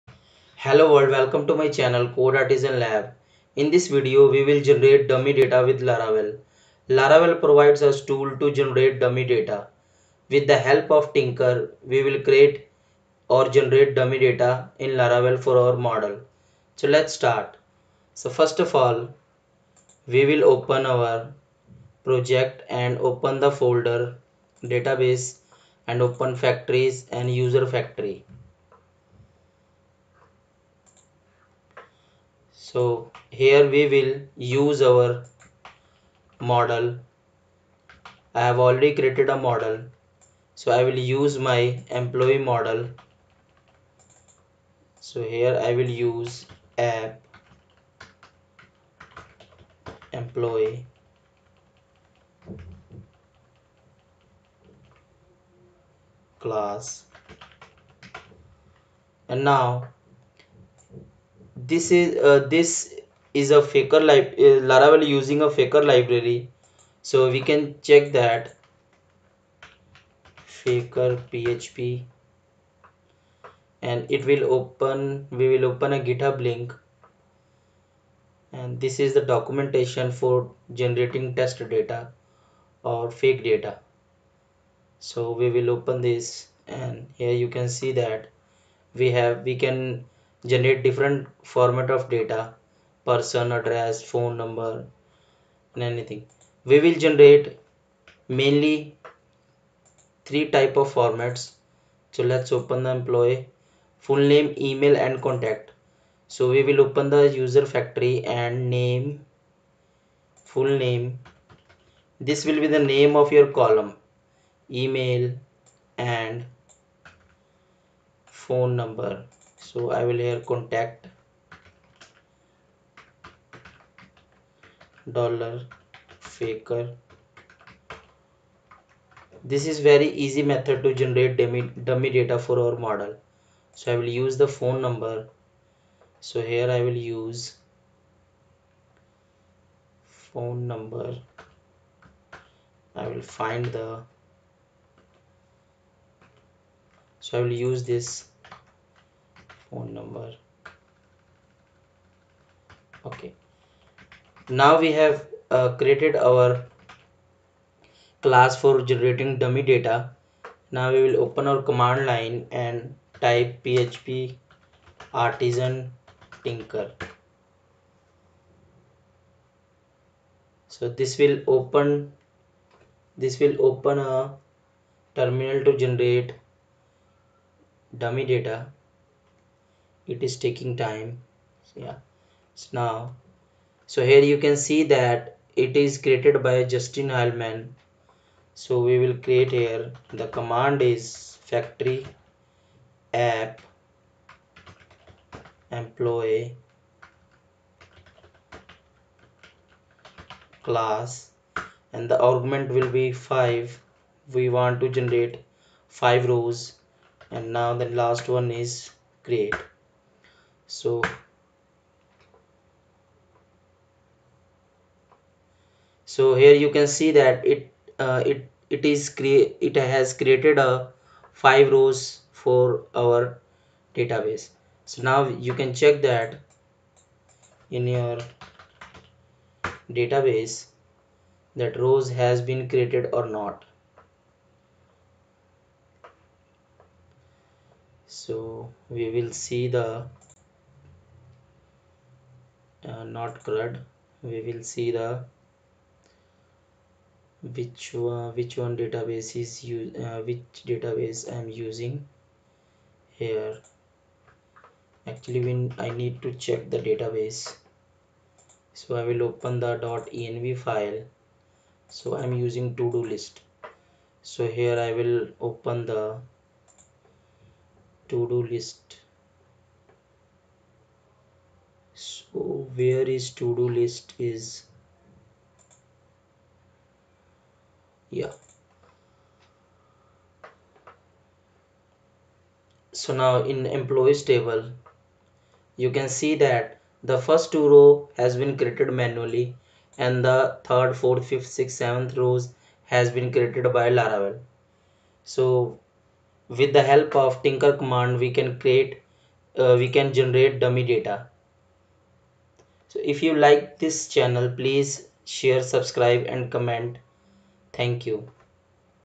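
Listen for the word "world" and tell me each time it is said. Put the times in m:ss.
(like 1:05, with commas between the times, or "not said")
0:00.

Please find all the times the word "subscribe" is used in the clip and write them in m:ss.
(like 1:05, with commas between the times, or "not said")
5:05.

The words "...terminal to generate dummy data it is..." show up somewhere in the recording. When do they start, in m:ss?
2:55.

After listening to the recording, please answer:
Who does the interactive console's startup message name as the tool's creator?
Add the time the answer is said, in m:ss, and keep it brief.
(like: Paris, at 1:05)
Justin Hileman, at 3:06.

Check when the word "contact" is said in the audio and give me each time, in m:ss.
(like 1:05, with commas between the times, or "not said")
1:45, 2:00.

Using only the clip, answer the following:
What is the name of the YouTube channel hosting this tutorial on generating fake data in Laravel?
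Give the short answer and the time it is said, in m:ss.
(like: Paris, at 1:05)
Code Artisan Lab, at 0:02.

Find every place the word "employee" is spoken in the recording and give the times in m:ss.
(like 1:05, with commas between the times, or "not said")
0:42, 0:50, 1:42, 3:15, 4:43.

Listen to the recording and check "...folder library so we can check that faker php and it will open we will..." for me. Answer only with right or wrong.
wrong.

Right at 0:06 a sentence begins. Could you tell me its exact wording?
Laravel provides us tool to generate dummy data.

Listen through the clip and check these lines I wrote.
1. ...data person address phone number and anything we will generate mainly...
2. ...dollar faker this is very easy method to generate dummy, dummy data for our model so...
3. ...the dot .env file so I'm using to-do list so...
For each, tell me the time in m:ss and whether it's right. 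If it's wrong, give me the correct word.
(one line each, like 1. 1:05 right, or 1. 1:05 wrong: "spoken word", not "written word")
1. 1:32 right
2. 2:05 right
3. 4:19 right.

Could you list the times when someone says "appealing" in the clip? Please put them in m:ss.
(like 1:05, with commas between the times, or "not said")
not said.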